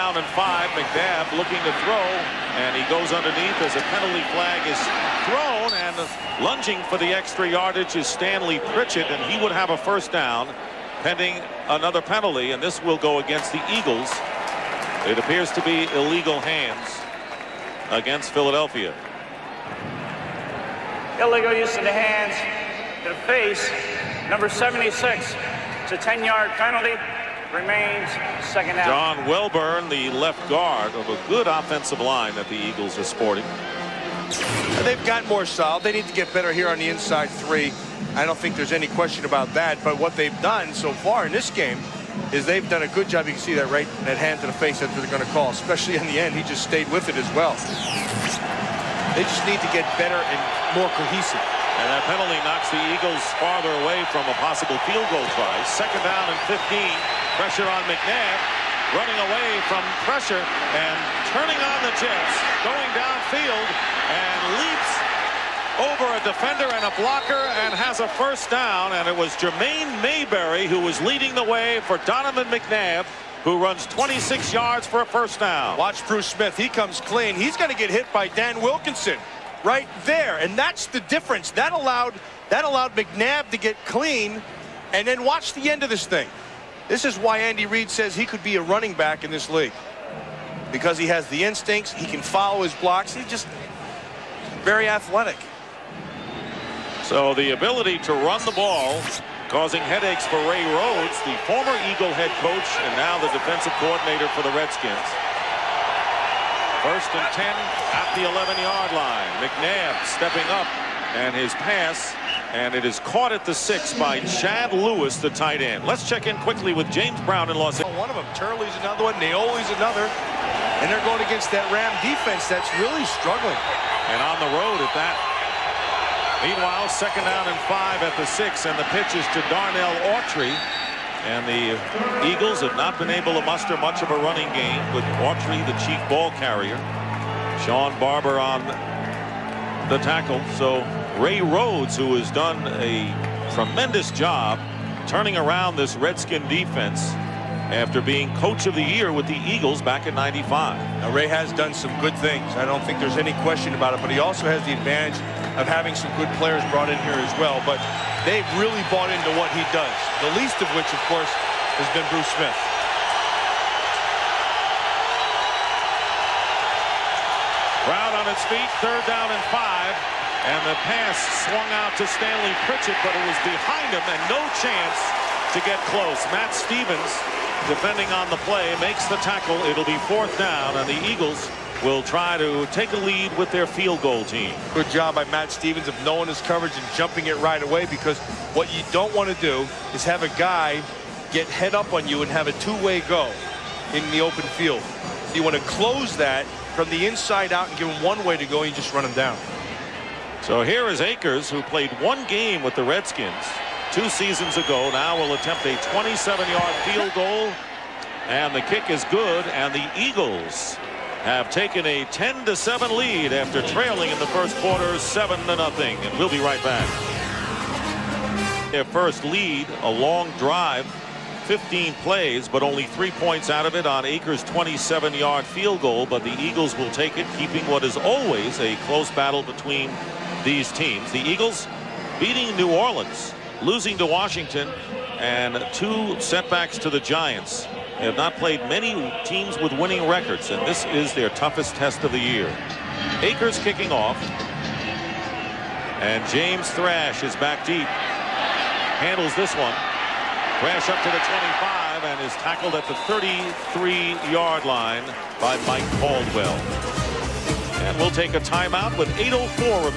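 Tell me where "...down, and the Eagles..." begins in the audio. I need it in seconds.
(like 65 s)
180 s.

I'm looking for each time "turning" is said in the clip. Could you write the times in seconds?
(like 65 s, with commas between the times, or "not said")
61 s, 145 s.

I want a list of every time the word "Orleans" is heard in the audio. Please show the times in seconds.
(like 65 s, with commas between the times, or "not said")
232 s.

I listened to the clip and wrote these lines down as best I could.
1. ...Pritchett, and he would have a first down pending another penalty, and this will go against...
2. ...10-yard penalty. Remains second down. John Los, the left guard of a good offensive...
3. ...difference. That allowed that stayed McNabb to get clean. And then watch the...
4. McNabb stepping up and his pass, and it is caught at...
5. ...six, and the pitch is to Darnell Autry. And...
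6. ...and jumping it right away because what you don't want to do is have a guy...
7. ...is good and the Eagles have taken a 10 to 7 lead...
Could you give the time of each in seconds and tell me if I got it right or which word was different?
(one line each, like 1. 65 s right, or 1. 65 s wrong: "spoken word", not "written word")
1. 8 s right
2. 25 s wrong: "Welbourn", not "Los"
3. 81 s wrong: "allowed", not "stayed"
4. 109 s right
5. 128 s right
6. 186 s right
7. 208 s right.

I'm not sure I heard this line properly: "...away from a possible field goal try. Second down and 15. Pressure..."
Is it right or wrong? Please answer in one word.
right.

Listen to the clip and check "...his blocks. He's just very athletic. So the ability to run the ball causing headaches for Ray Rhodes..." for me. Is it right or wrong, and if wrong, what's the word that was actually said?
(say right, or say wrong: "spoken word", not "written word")
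right.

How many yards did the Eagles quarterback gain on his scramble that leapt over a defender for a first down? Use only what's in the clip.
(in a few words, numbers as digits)
26.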